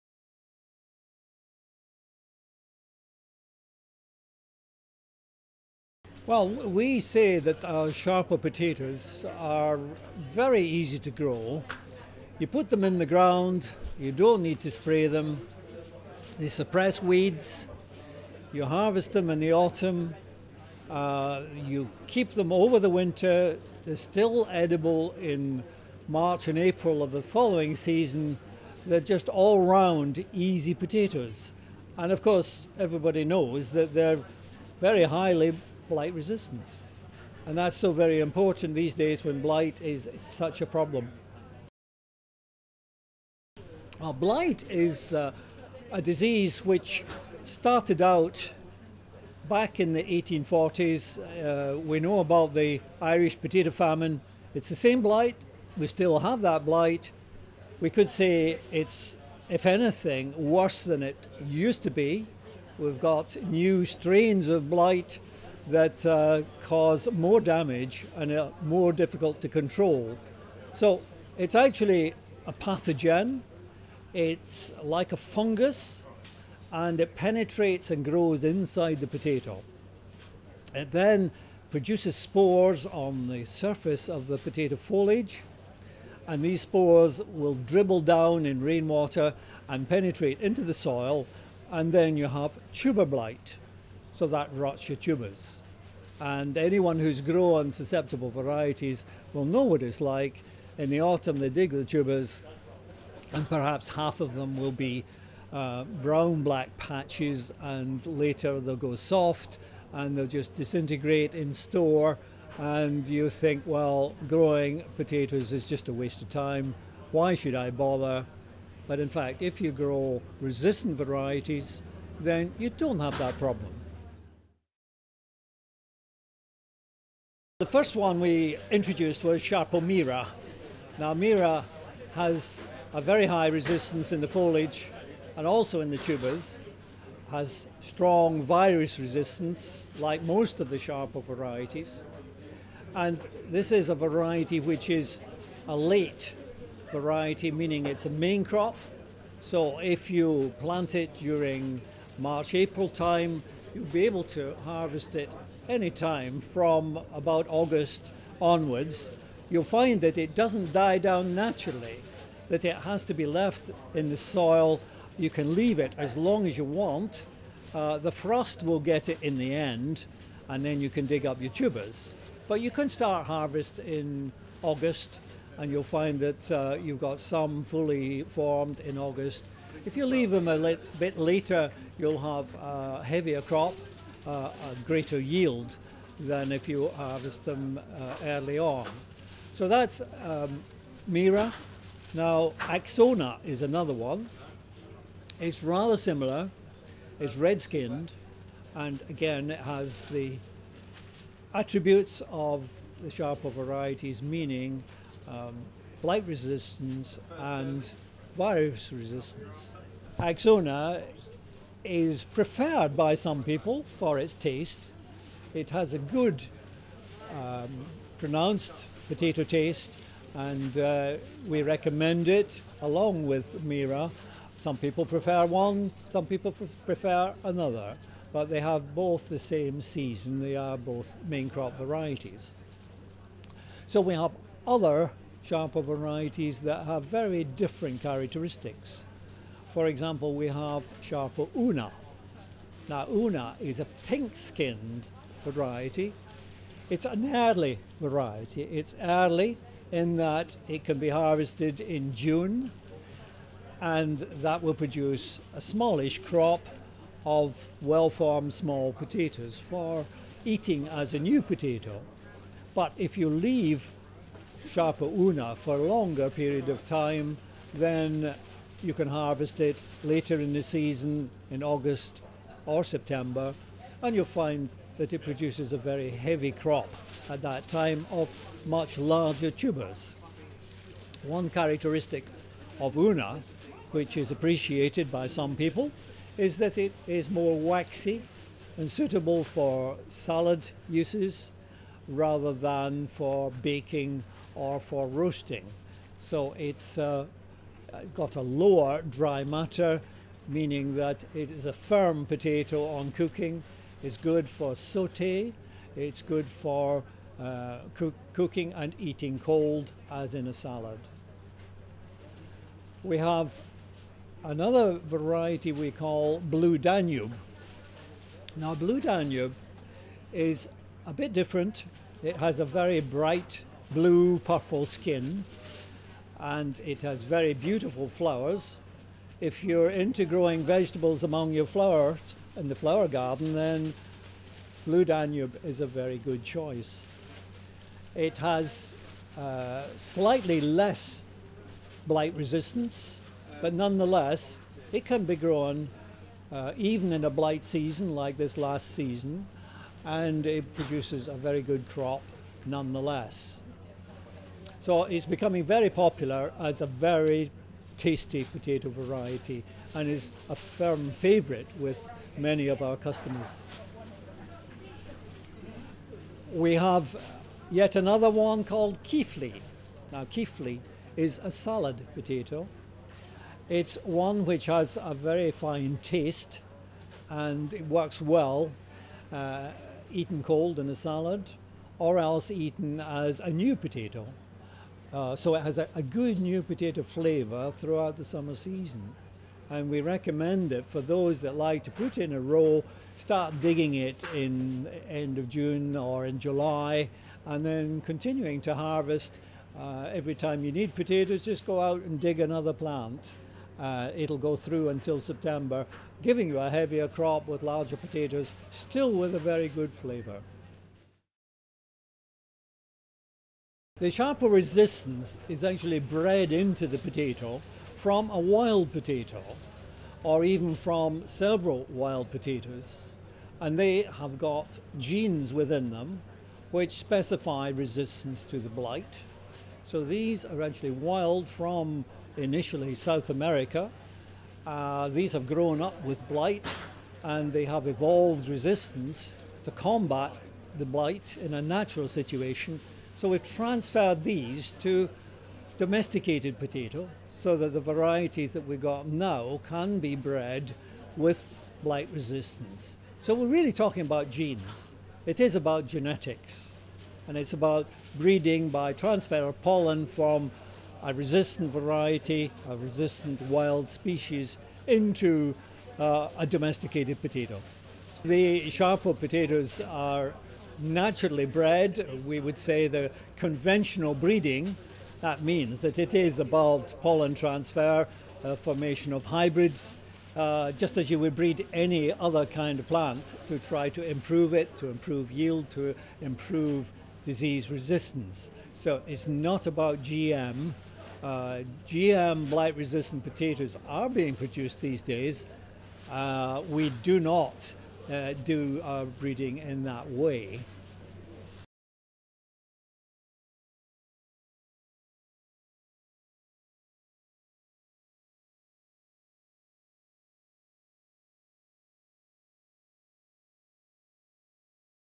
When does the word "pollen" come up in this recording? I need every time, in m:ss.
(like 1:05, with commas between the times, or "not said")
7:39, 7:57.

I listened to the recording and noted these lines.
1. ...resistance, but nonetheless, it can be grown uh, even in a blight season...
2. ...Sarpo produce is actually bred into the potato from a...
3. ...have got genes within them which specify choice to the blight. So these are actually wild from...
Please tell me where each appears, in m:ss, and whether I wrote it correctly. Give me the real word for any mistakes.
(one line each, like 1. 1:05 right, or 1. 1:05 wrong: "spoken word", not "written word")
1. 5:42 right
2. 6:54 wrong: "resistance", not "produce"
3. 7:04 wrong: "resistance", not "choice".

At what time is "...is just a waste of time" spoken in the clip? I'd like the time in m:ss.
1:55.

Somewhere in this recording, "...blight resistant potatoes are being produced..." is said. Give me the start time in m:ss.
8:12.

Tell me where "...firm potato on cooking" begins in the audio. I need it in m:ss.
5:01.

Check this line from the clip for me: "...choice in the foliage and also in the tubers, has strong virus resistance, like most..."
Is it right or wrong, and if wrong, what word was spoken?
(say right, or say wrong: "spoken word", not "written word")
wrong: "resistance", not "choice".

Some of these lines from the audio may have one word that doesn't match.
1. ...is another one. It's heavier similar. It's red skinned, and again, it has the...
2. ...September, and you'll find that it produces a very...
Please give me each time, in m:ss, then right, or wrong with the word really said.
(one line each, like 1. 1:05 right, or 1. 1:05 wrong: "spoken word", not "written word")
1. 3:13 wrong: "rather", not "heavier"
2. 4:32 right.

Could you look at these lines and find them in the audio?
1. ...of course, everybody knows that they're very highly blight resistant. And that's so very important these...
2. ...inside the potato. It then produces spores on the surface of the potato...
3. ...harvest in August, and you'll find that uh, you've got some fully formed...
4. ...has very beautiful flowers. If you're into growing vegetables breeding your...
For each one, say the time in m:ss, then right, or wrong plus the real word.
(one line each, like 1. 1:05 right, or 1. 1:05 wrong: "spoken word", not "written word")
1. 0:32 right
2. 1:18 right
3. 2:53 right
4. 5:27 wrong: "among", not "breeding".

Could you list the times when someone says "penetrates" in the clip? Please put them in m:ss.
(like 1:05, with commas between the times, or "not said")
1:17, 1:29.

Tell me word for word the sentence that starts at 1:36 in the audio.
And anyone who's grown susceptible varieties will know what it's like.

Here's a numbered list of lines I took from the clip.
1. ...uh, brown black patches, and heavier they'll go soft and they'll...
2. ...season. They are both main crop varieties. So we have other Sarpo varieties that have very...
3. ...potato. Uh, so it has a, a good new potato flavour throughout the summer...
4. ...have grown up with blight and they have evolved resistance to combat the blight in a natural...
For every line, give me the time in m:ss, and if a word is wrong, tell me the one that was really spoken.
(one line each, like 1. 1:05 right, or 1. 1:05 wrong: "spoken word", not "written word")
1. 1:45 wrong: "later", not "heavier"
2. 3:49 right
3. 6:23 right
4. 7:15 right.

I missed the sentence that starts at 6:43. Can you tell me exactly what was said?
Uh, it'll go through until September, giving you a heavier crop with larger potatoes, still with a very good flavour.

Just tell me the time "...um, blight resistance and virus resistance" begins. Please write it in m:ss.
3:25.